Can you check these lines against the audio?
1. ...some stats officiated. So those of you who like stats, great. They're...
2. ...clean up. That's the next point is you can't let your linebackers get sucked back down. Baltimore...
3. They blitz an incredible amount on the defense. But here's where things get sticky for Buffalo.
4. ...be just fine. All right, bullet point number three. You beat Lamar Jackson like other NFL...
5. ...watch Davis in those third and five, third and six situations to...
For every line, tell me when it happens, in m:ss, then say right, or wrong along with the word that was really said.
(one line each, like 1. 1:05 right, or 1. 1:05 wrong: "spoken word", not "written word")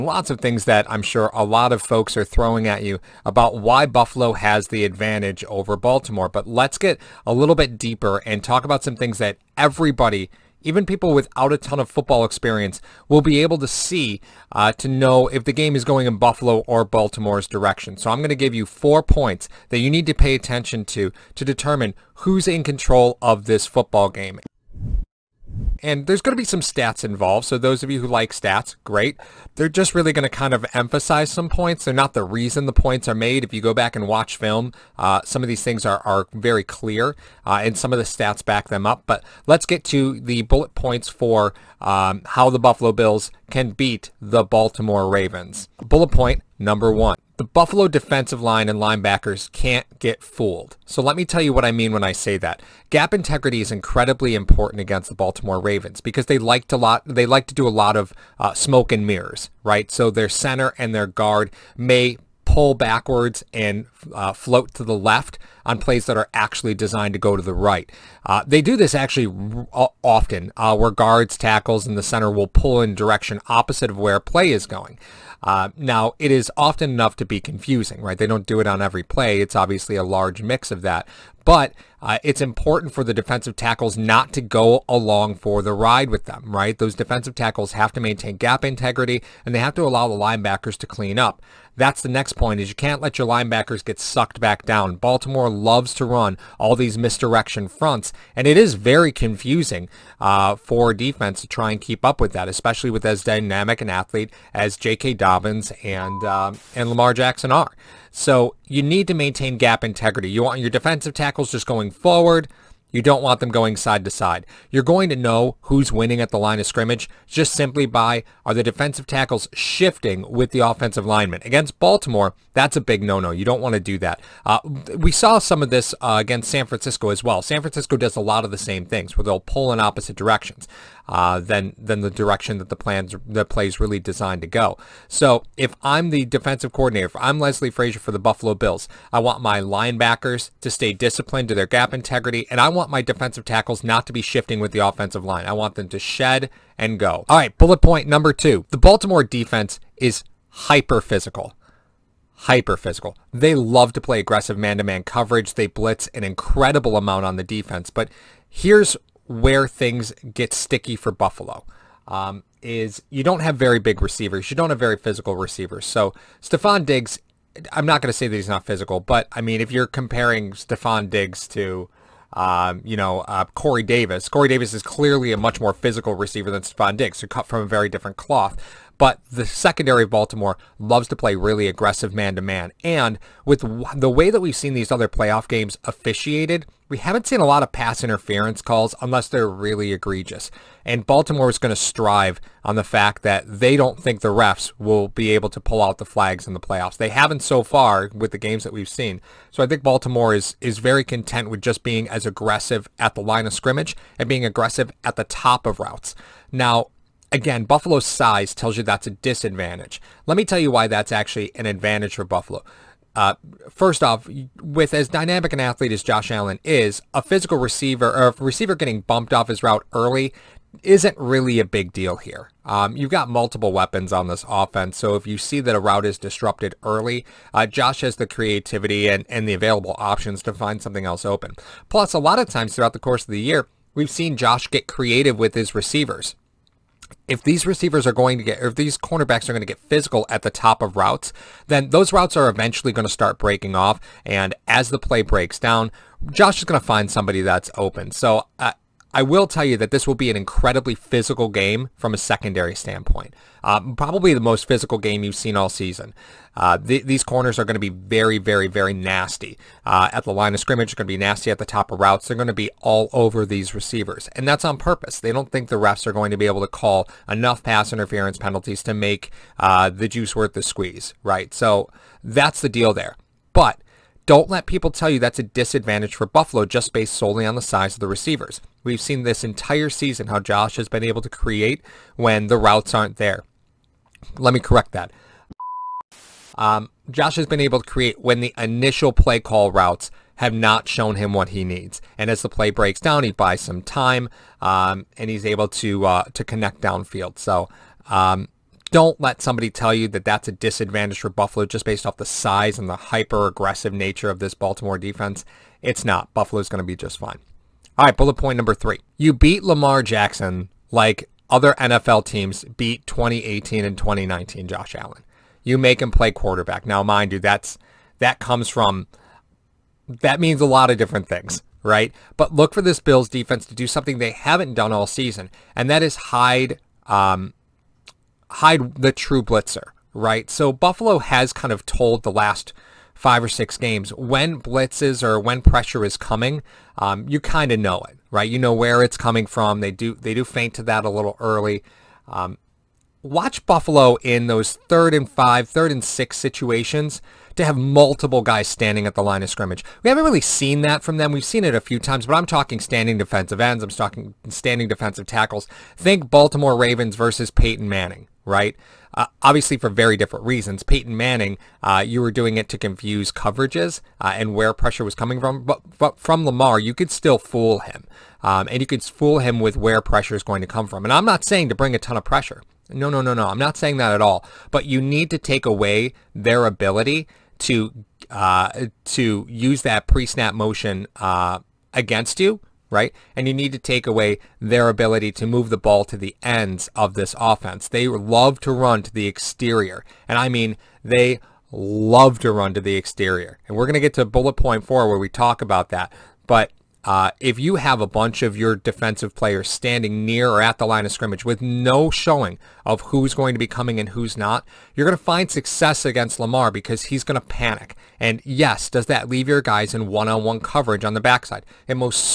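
1. 0:26 wrong: "involved", not "officiated"
2. 1:30 right
3. 2:35 right
4. 5:06 right
5. 5:43 wrong: "Buffalo", not "Davis".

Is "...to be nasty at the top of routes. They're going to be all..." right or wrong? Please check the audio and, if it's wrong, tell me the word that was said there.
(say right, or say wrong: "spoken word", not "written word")
right.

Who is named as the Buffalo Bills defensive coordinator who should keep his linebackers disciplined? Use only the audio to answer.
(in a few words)
Leslie Frazier.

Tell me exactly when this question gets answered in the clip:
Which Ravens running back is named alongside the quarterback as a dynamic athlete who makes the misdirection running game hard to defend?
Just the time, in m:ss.
1:44.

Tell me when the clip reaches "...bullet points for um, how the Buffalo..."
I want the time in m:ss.
0:40.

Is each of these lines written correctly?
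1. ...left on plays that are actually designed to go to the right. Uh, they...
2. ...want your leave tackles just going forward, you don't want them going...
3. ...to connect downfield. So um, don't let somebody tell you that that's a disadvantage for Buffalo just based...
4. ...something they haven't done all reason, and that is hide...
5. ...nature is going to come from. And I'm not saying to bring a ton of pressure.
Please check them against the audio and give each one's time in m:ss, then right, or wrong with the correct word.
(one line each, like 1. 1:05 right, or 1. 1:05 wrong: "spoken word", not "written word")
1. 1:04 right
2. 1:50 wrong: "defensive", not "leave"
3. 4:56 right
4. 5:23 wrong: "season", not "reason"
5. 6:10 wrong: "pressure", not "nature".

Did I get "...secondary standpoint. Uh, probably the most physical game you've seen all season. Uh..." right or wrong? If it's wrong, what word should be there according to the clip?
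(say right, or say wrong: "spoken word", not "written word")
right.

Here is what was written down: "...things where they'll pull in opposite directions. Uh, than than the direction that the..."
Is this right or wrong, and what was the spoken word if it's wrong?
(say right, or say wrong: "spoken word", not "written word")
right.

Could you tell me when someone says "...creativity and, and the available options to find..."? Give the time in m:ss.
3:48.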